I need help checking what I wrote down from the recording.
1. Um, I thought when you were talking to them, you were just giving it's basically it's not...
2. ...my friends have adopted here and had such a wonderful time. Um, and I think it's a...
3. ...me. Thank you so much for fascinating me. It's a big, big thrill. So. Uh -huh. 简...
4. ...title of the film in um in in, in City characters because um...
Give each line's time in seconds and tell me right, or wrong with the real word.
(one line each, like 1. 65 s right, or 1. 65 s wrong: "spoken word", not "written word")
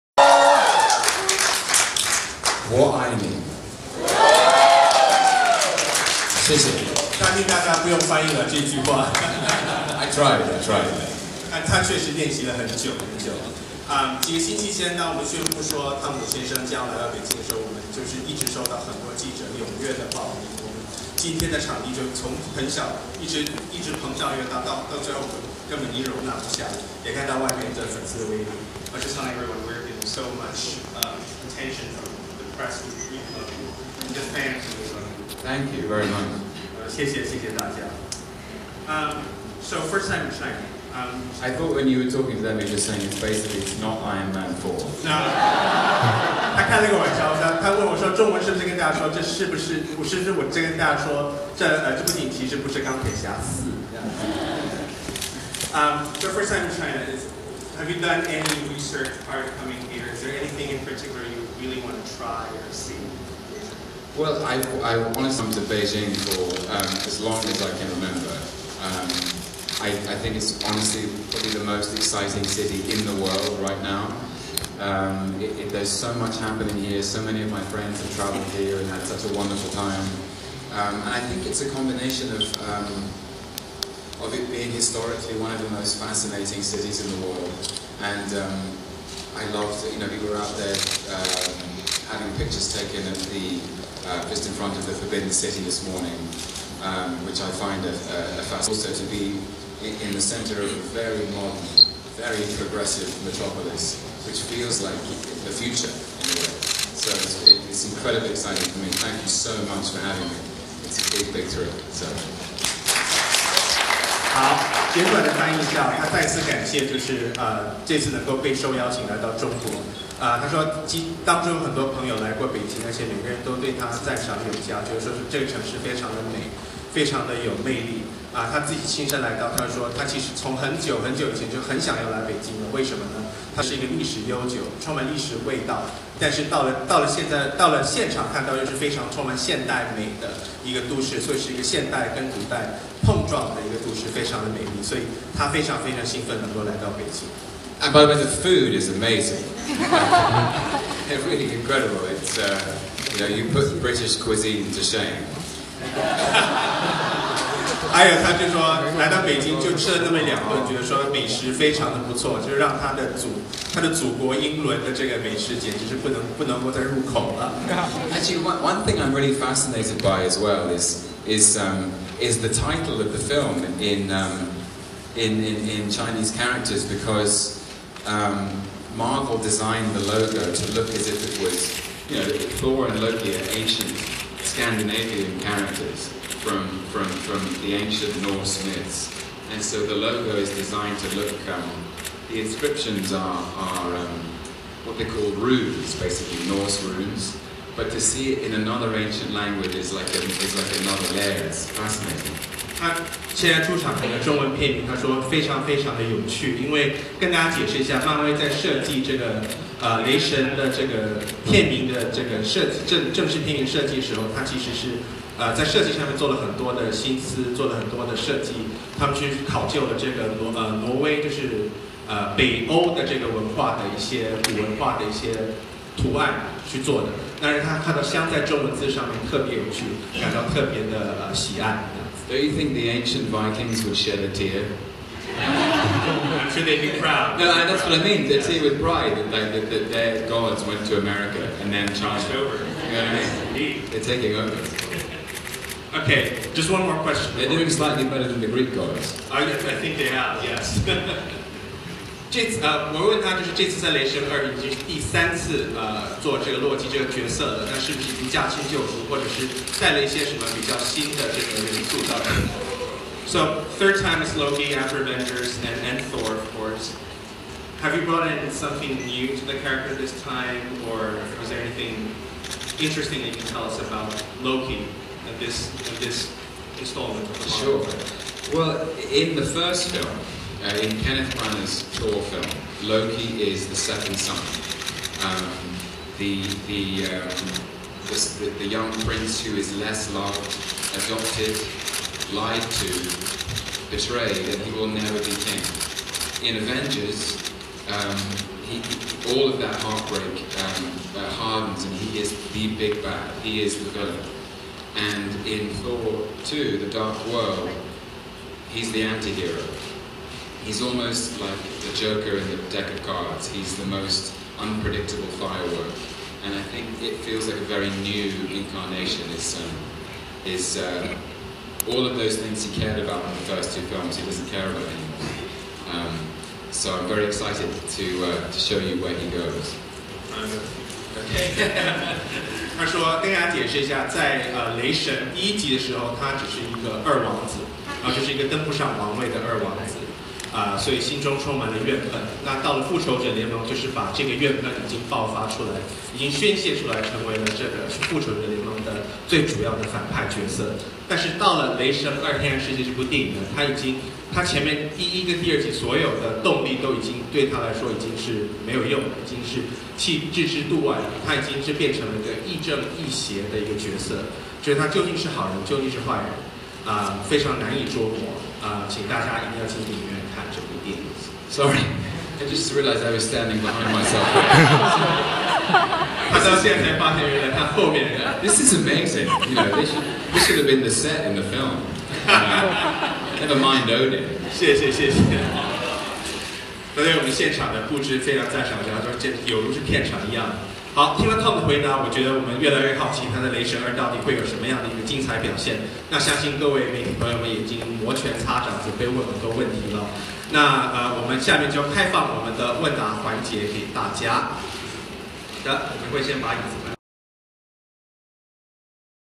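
1. 40 s wrong: "saying", not "giving"
2. 77 s wrong: "traveled", not "adopted"
3. 108 s wrong: "having", not "fascinating"
4. 172 s wrong: "Chinese", not "City".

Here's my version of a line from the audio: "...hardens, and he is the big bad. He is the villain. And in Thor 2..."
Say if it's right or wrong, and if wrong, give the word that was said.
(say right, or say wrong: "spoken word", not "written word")
right.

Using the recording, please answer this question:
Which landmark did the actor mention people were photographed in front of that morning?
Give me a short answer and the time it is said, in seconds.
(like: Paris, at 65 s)
Forbidden City, at 94 s.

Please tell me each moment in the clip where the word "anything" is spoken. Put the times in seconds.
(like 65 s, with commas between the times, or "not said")
60 s, 271 s.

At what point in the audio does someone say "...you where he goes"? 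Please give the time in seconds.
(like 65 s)
328 s.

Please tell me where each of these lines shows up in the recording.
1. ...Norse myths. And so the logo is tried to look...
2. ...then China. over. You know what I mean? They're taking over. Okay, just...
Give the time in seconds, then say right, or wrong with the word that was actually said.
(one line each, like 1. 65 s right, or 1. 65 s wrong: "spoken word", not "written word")
1. 188 s wrong: "designed", not "tried"
2. 241 s right.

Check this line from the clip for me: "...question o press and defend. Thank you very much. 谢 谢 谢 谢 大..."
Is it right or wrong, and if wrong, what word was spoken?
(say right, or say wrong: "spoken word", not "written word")
wrong: "attention", not "question".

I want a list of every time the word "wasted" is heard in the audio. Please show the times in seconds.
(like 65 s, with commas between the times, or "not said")
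not said.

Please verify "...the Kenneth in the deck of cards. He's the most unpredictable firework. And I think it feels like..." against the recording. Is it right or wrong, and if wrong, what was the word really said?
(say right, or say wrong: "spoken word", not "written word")
wrong: "Joker", not "Kenneth".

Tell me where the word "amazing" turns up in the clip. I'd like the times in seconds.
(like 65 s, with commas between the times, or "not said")
148 s, 378 s.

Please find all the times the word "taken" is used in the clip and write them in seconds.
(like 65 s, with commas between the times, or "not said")
92 s.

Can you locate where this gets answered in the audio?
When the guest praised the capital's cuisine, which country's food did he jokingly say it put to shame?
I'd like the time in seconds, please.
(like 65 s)
153 s.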